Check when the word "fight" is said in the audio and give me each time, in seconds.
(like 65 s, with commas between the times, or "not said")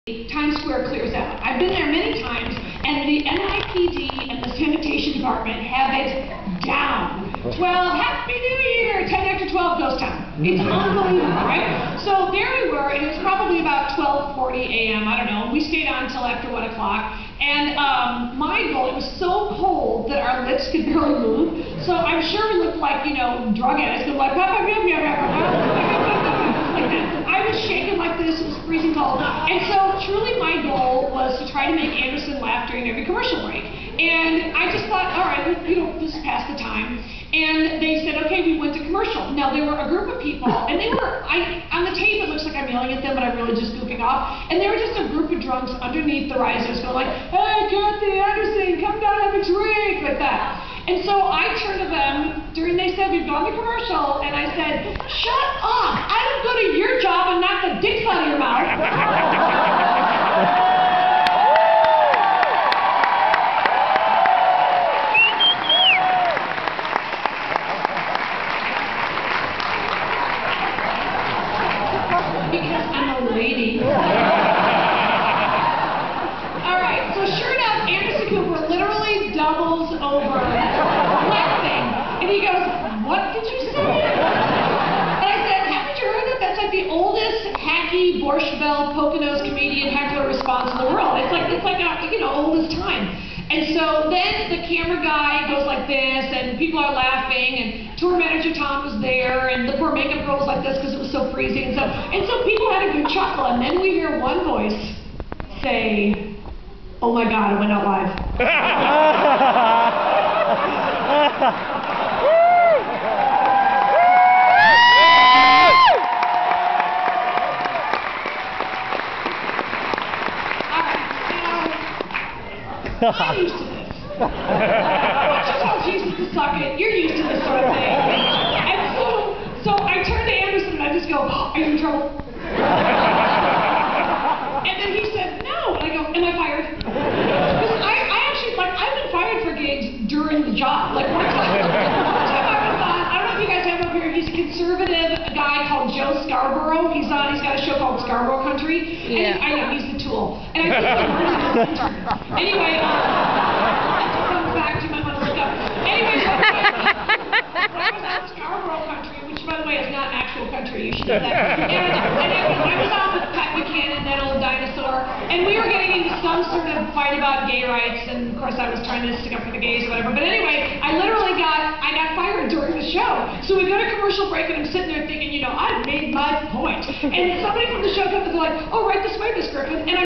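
166 s.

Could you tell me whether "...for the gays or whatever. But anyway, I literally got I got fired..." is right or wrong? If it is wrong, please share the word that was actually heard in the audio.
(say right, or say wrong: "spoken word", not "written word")
right.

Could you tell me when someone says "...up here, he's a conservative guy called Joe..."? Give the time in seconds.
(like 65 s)
143 s.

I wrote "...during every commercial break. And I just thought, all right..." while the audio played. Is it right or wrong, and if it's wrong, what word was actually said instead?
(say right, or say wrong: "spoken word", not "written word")
right.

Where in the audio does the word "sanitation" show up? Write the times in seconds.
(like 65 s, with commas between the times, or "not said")
4 s.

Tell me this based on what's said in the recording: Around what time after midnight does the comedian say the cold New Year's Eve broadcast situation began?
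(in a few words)
12:40 a.m.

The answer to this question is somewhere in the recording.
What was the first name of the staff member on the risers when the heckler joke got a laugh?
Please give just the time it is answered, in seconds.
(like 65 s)
97 s.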